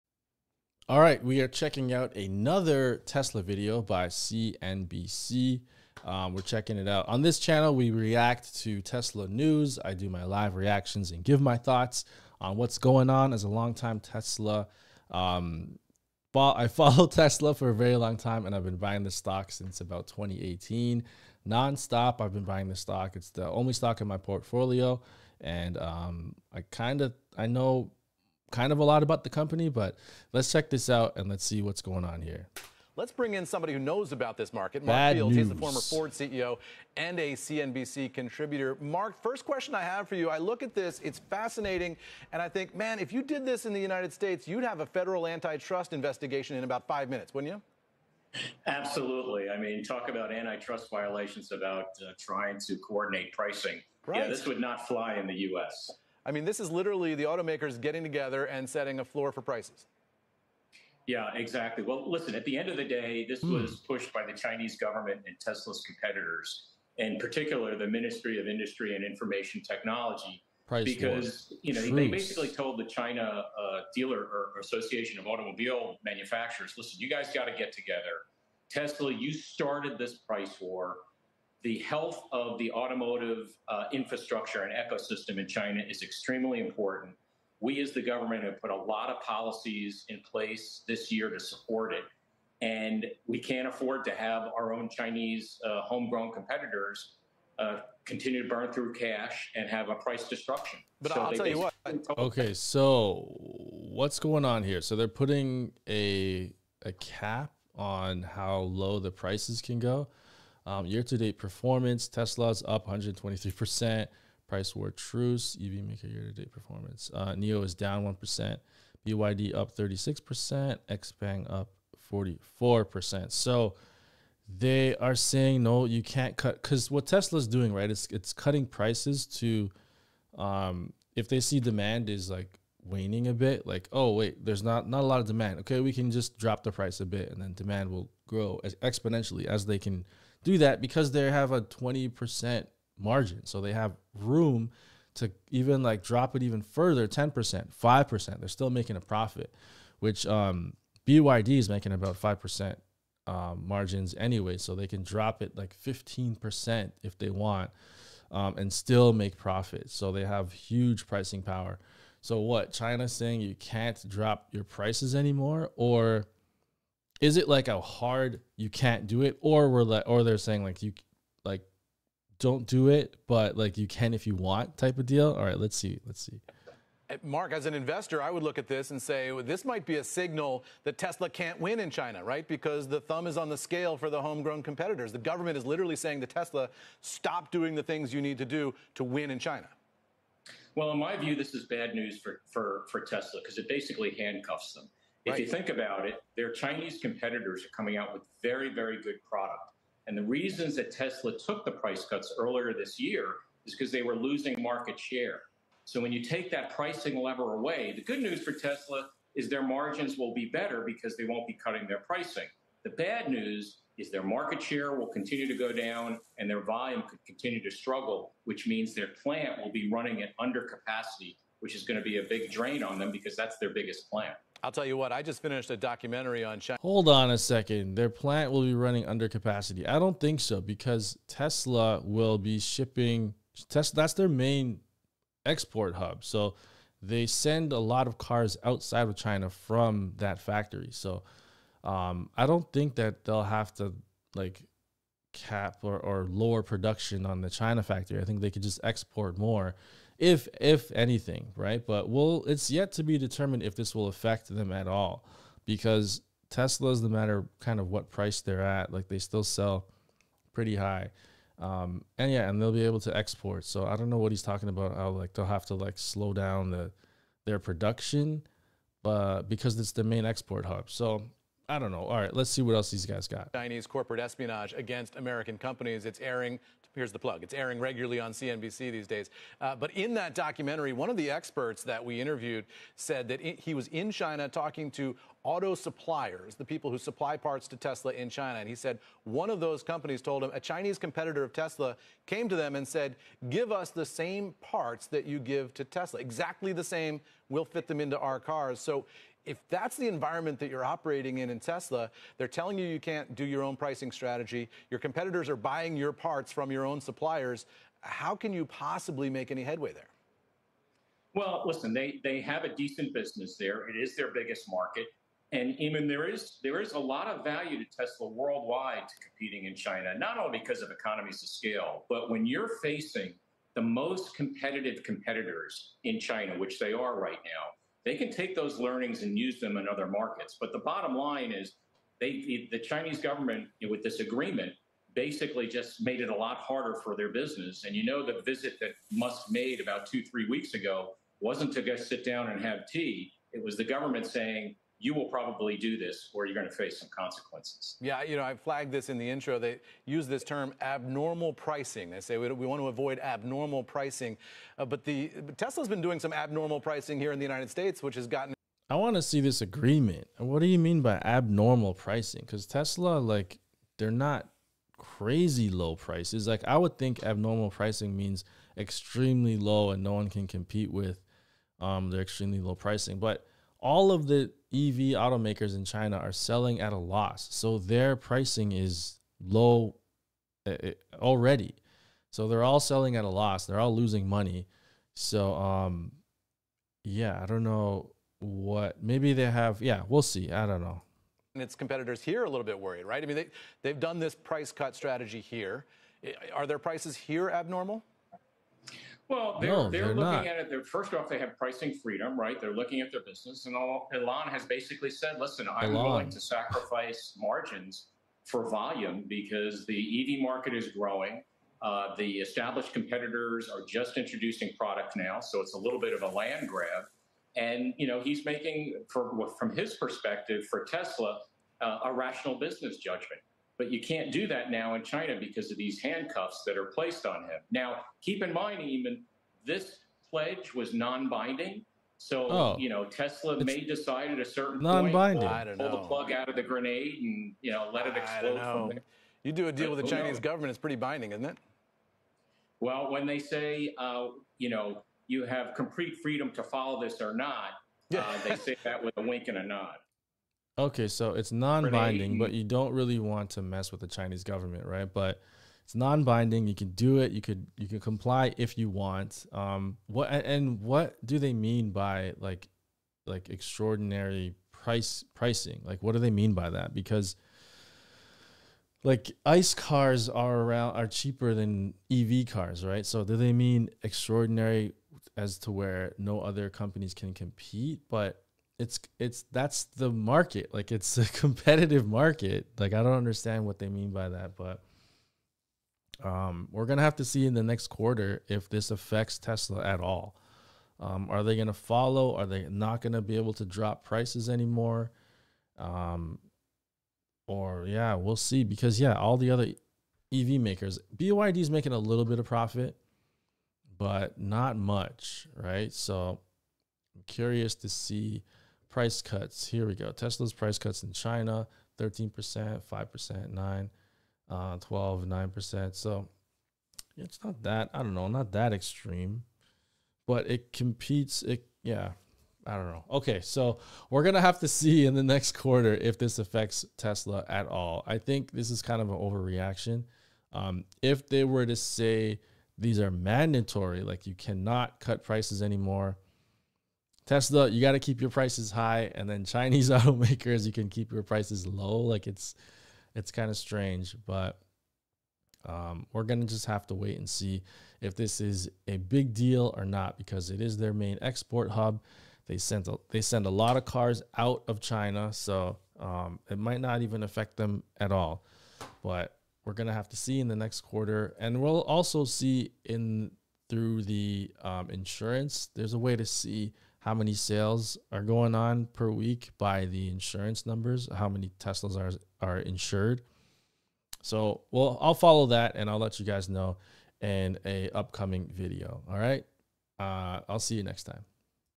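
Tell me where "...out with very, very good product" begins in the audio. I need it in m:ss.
3:17.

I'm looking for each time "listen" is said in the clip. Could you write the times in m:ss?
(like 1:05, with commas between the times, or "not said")
1:02, 1:16, 5:11, 6:45.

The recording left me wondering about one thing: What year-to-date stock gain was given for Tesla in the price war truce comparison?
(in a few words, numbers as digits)
123%.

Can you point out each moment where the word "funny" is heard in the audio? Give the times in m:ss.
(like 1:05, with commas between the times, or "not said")
not said.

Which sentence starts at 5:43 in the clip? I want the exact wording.
It was the government saying, you will probably do this or you're going to face some consequences.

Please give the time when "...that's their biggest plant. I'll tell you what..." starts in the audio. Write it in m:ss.
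3:43.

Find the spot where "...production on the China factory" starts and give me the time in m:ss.
4:06.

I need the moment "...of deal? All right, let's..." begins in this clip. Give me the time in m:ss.
2:54.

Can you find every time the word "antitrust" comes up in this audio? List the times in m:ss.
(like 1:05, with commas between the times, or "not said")
0:45, 0:50.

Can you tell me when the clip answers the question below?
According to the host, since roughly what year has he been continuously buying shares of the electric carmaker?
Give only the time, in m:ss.
0:20.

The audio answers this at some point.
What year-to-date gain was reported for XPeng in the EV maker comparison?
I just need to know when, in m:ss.
2:02.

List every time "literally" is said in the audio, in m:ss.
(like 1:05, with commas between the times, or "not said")
0:56, 3:05.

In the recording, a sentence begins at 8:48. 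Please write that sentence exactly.
I think this is kind of an overreaction.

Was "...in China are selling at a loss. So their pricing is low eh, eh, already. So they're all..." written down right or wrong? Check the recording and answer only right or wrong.
right.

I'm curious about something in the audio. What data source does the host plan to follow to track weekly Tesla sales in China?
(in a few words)
insurance numbers.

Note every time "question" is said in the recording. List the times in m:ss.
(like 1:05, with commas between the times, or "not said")
0:39.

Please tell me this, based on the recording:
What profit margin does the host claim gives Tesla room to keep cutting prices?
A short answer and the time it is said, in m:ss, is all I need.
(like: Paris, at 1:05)
20%, at 2:21.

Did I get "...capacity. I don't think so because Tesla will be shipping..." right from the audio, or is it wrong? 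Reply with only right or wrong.
right.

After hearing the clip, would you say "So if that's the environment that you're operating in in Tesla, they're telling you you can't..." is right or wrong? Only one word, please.
right.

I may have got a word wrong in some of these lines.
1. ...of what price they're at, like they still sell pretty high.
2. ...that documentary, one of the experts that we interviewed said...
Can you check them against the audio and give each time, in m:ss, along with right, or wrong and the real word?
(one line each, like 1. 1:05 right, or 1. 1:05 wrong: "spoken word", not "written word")
1. 4:17 right
2. 4:40 right.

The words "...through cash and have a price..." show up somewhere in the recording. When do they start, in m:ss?
1:38.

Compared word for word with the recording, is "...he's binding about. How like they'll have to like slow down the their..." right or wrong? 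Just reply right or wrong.
wrong.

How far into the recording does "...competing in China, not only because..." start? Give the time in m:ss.
5:19.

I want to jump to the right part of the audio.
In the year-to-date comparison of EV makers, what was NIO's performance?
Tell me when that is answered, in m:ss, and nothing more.
1:57.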